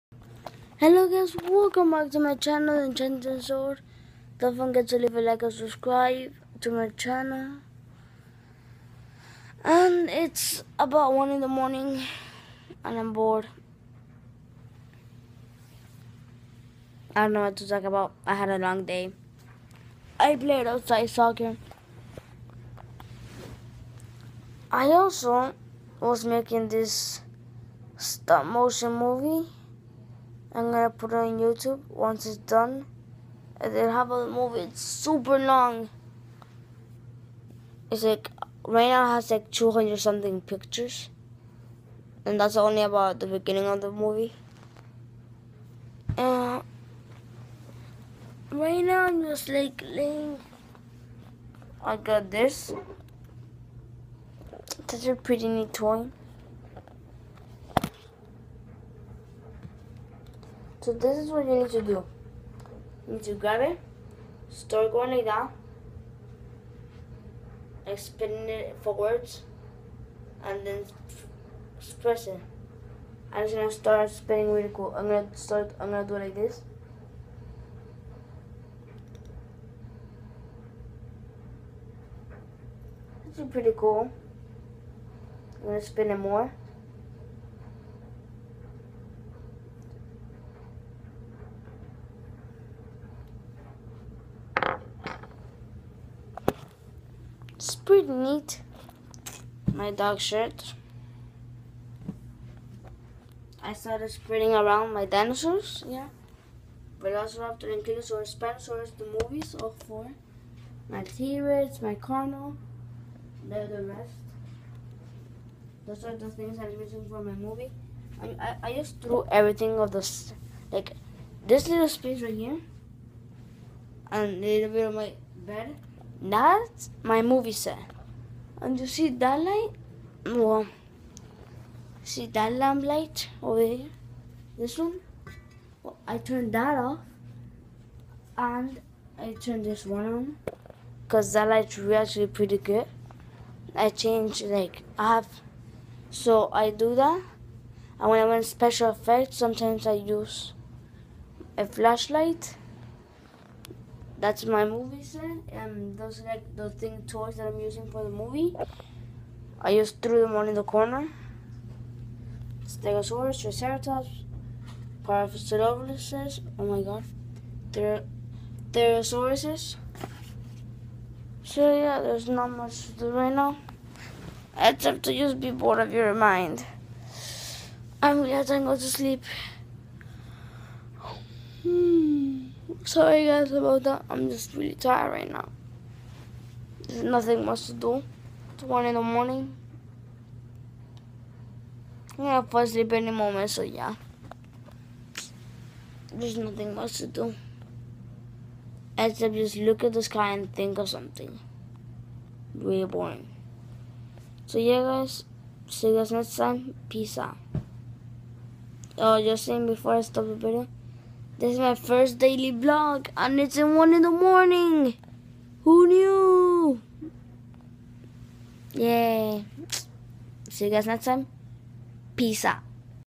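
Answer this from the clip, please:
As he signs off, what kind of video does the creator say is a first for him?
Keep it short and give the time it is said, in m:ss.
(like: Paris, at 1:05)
daily vlog, at 3:32.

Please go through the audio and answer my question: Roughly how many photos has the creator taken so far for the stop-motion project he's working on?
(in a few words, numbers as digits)
200 something.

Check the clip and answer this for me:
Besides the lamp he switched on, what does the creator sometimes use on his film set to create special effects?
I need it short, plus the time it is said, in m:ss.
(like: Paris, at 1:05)
a flashlight, at 2:31.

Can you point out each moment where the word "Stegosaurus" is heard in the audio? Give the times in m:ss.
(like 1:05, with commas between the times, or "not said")
2:42.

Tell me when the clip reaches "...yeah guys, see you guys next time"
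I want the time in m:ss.
3:24.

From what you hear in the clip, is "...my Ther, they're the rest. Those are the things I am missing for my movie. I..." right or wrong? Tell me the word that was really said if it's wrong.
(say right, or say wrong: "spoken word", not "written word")
wrong: "Carnal", not "Ther".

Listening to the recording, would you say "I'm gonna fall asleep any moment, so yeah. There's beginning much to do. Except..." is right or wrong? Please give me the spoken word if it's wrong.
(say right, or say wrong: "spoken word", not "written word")
wrong: "nothing", not "beginning".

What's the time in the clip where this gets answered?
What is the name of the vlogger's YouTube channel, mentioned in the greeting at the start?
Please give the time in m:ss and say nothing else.
0:02.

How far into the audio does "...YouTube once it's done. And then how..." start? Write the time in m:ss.
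0:31.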